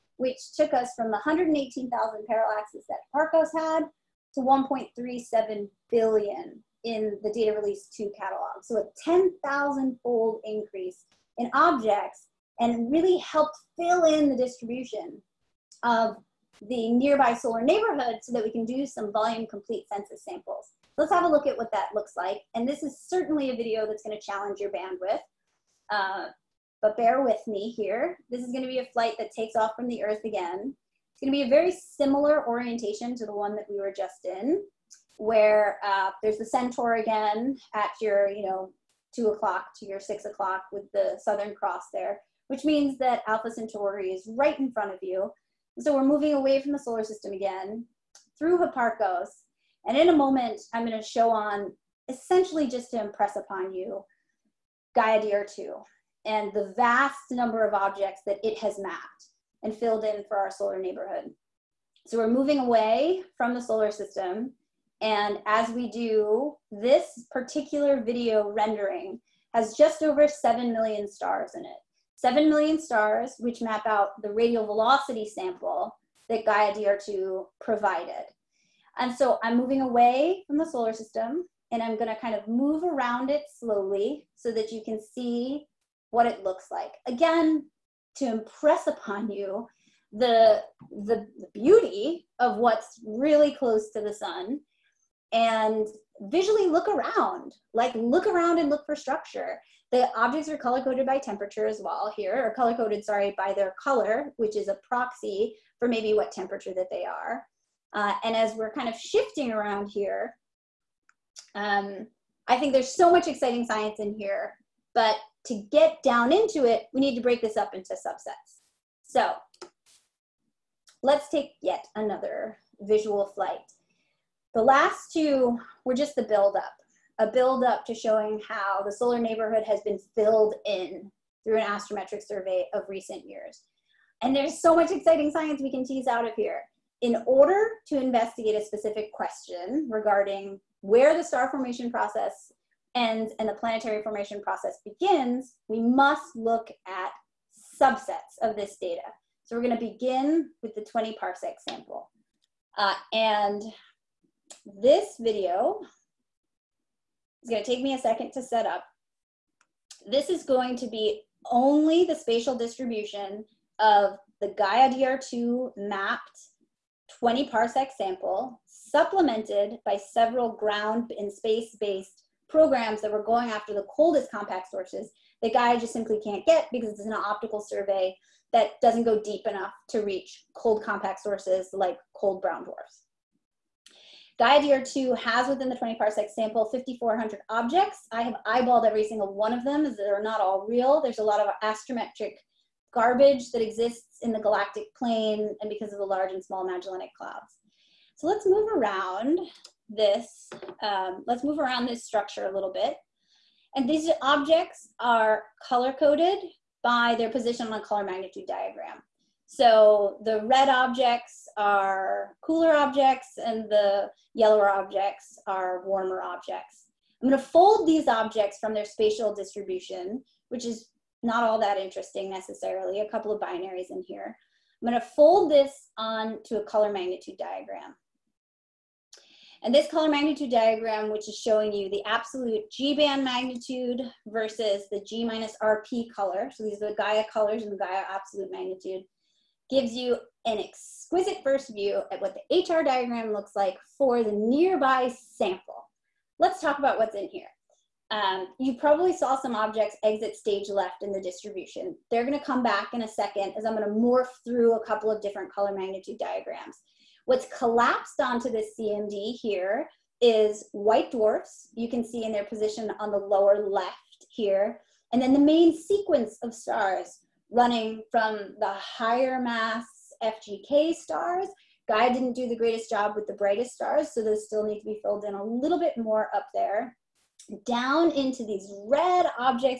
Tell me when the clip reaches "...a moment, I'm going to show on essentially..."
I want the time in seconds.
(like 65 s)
50 s.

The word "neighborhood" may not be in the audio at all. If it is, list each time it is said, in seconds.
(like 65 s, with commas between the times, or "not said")
17 s, 60 s, 129 s.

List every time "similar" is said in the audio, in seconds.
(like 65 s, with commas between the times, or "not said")
31 s.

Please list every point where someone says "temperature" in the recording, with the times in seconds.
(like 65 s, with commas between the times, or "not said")
101 s, 106 s.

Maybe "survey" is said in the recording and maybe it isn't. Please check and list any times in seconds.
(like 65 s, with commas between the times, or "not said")
132 s, 177 s.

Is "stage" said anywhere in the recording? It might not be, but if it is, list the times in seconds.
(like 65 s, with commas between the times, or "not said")
250 s.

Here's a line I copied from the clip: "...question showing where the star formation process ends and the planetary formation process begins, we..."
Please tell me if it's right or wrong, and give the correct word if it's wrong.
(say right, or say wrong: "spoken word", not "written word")
wrong: "regarding", not "showing".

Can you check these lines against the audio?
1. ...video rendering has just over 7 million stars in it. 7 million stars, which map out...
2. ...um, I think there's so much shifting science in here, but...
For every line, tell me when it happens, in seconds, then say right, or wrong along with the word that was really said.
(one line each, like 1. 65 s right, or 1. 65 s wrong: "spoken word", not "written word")
1. 68 s right
2. 111 s wrong: "exciting", not "shifting".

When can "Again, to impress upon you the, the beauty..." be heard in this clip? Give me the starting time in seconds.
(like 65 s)
87 s.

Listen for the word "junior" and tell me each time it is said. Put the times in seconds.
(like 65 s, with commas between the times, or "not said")
not said.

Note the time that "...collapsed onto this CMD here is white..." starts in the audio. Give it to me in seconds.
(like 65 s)
257 s.